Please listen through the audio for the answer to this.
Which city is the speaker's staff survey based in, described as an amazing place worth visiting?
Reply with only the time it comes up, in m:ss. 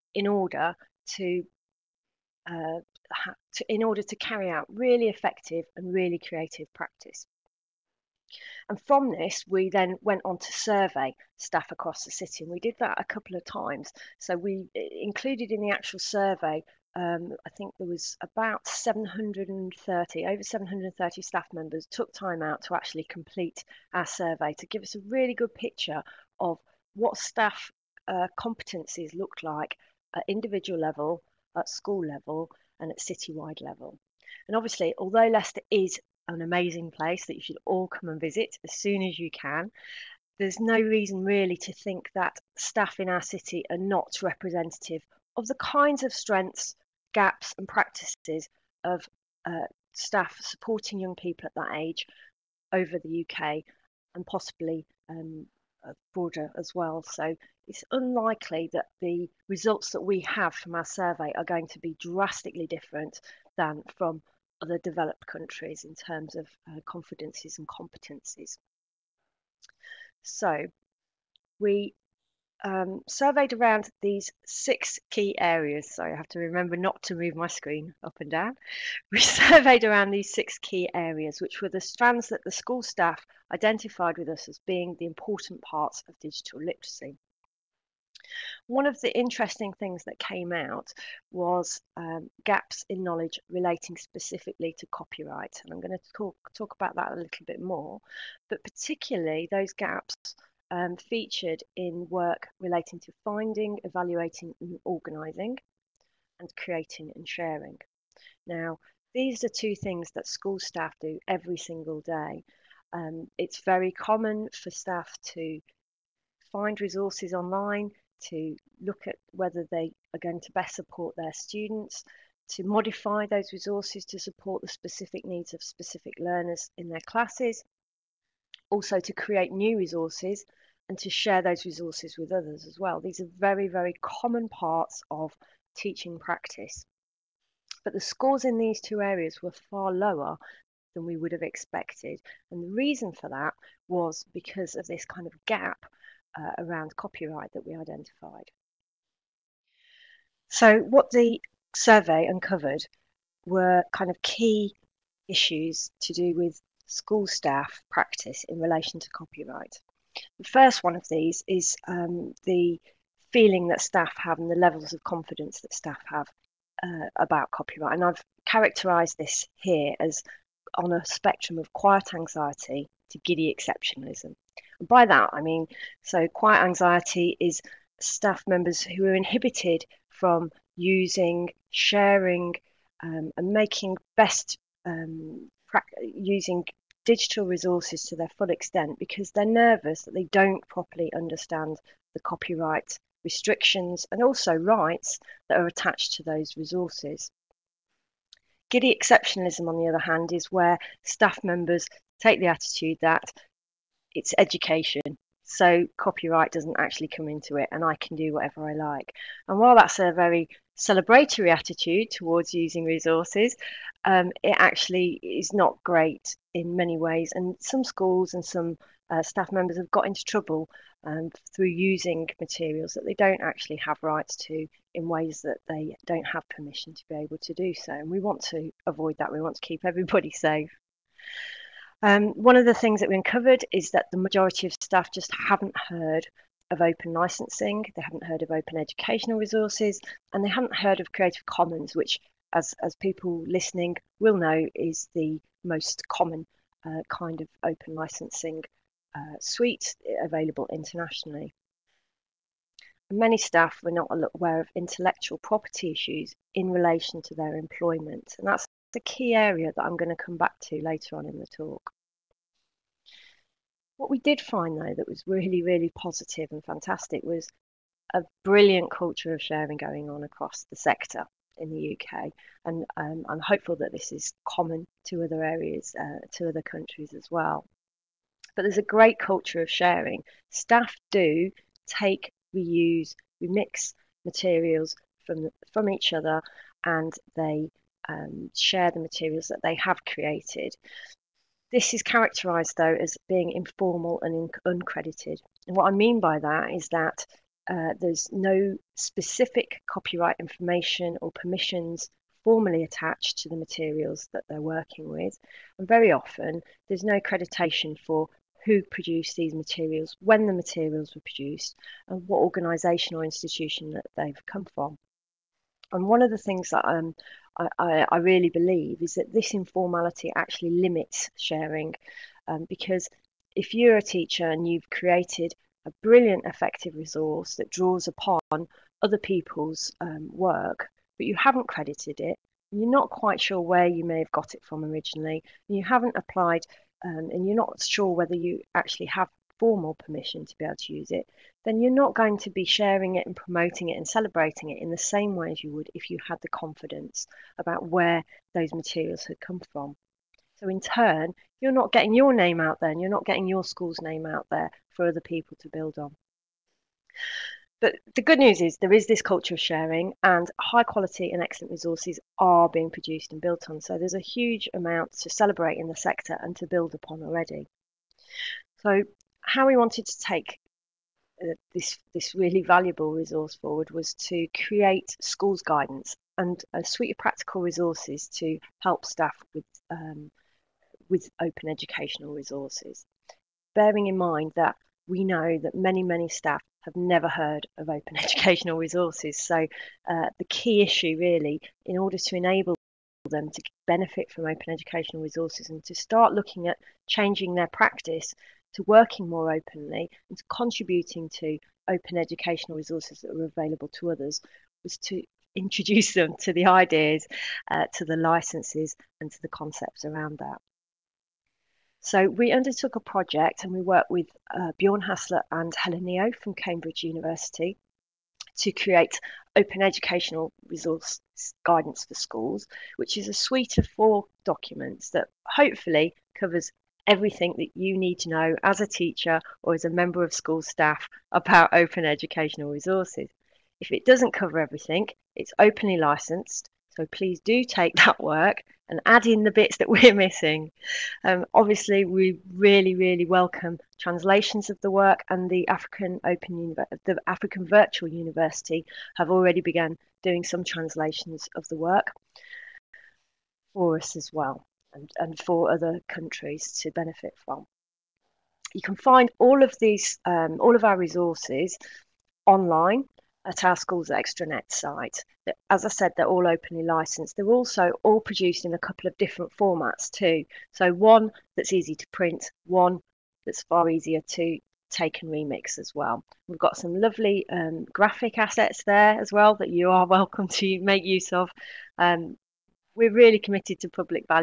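0:35.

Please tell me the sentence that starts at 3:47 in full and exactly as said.
And we want to avoid that.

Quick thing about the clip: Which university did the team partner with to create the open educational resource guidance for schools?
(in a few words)
Cambridge University.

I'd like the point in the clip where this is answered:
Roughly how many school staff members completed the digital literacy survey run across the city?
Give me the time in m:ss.
0:20.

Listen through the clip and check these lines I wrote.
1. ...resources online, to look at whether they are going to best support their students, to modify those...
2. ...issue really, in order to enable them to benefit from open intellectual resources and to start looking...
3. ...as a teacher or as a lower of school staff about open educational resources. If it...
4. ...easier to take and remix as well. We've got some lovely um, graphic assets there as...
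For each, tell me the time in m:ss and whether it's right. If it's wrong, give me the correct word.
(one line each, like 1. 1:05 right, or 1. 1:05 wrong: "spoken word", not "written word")
1. 1:56 right
2. 6:30 wrong: "educational", not "intellectual"
3. 7:08 wrong: "member", not "lower"
4. 7:53 right.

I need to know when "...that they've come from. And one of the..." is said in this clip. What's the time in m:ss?
5:13.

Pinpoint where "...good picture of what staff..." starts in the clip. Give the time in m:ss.
0:25.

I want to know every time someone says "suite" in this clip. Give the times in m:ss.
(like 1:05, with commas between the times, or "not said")
4:09, 6:16, 7:03.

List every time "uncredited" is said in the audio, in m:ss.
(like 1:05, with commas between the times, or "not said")
4:54.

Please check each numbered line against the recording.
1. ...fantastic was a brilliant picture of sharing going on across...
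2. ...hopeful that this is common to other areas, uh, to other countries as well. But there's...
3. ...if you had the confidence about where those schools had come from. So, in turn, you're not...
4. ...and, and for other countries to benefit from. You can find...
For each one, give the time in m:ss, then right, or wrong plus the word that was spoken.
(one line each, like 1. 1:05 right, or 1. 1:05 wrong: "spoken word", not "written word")
1. 4:26 wrong: "culture", not "picture"
2. 4:33 right
3. 5:45 wrong: "materials", not "schools"
4. 7:34 right.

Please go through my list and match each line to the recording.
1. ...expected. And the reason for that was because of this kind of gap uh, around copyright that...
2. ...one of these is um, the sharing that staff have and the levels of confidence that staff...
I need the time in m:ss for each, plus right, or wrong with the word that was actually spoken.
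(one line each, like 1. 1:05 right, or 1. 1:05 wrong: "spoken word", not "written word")
1. 2:21 right
2. 2:40 wrong: "feeling", not "sharing".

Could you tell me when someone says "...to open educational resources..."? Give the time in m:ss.
6:41.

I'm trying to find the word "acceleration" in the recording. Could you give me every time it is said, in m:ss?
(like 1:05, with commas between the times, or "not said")
not said.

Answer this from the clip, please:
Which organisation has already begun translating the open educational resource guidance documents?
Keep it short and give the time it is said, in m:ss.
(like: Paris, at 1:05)
African Virtual University, at 7:27.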